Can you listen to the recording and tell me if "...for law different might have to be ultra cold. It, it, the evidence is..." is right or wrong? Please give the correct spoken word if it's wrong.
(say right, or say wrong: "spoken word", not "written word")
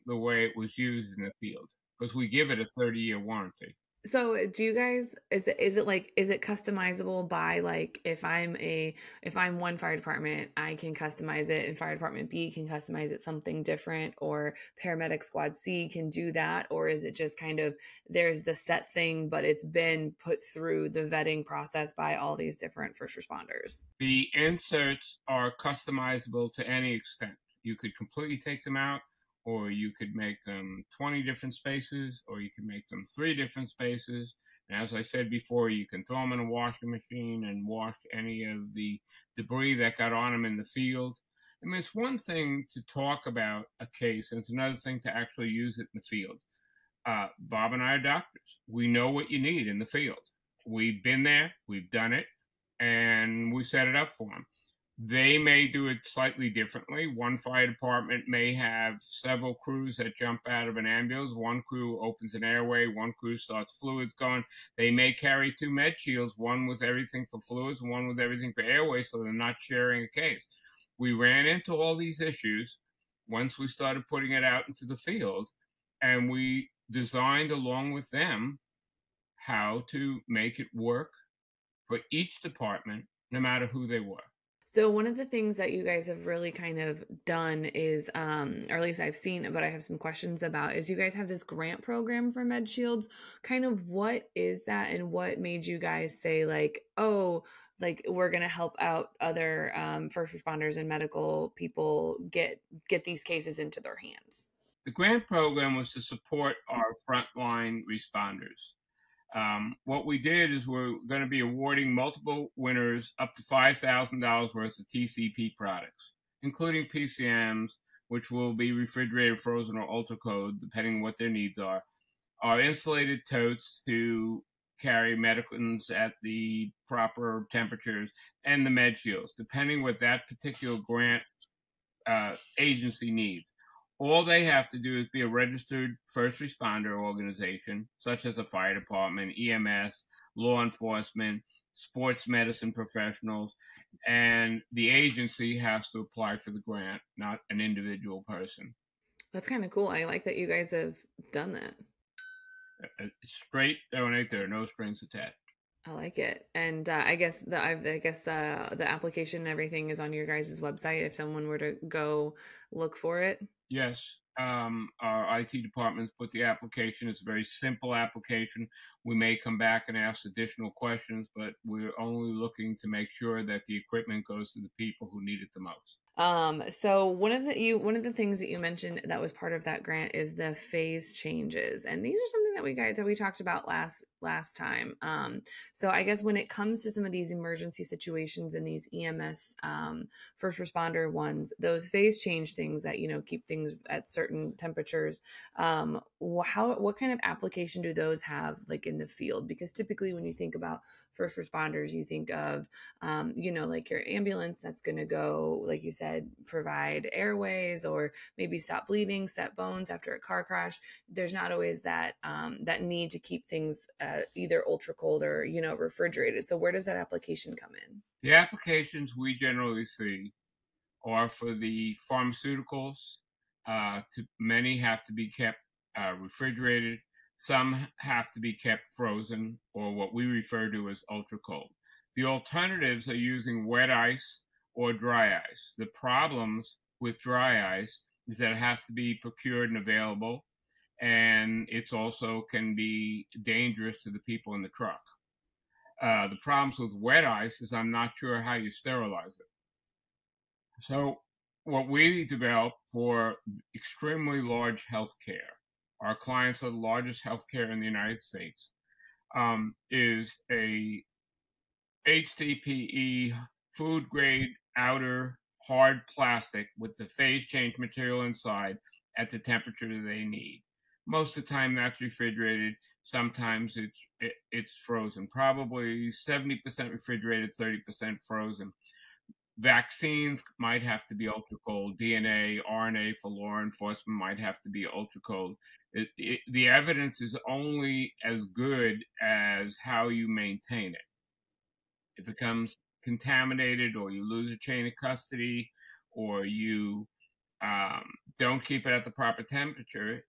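wrong: "enforcement", not "different".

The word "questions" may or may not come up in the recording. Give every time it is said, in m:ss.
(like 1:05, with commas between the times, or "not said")
1:29, 2:50.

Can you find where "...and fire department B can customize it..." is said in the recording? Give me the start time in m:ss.
0:11.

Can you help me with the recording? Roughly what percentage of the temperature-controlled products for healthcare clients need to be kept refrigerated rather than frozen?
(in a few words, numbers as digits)
70%.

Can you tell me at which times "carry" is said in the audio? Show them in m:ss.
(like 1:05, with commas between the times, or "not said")
1:05, 2:04.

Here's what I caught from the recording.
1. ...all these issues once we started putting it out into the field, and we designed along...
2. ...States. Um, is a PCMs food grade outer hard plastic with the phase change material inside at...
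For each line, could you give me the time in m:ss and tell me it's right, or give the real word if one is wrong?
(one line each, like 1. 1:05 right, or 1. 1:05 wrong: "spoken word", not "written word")
1. 1:11 right
2. 4:18 wrong: "HDPE", not "PCMs".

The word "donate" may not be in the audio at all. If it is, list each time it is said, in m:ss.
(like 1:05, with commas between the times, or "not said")
2:33.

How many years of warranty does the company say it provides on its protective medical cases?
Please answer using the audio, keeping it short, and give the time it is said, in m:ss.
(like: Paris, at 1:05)
30 years, at 0:02.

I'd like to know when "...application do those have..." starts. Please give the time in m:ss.
3:17.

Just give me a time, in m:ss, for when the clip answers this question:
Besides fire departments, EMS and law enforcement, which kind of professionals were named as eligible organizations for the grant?
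2:21.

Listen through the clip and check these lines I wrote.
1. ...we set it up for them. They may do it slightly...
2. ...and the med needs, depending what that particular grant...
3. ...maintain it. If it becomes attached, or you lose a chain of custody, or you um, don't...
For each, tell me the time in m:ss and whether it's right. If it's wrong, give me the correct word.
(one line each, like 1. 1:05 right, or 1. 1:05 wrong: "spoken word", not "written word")
1. 0:53 right
2. 2:08 wrong: "shields", not "needs"
3. 4:50 wrong: "contaminated", not "attached".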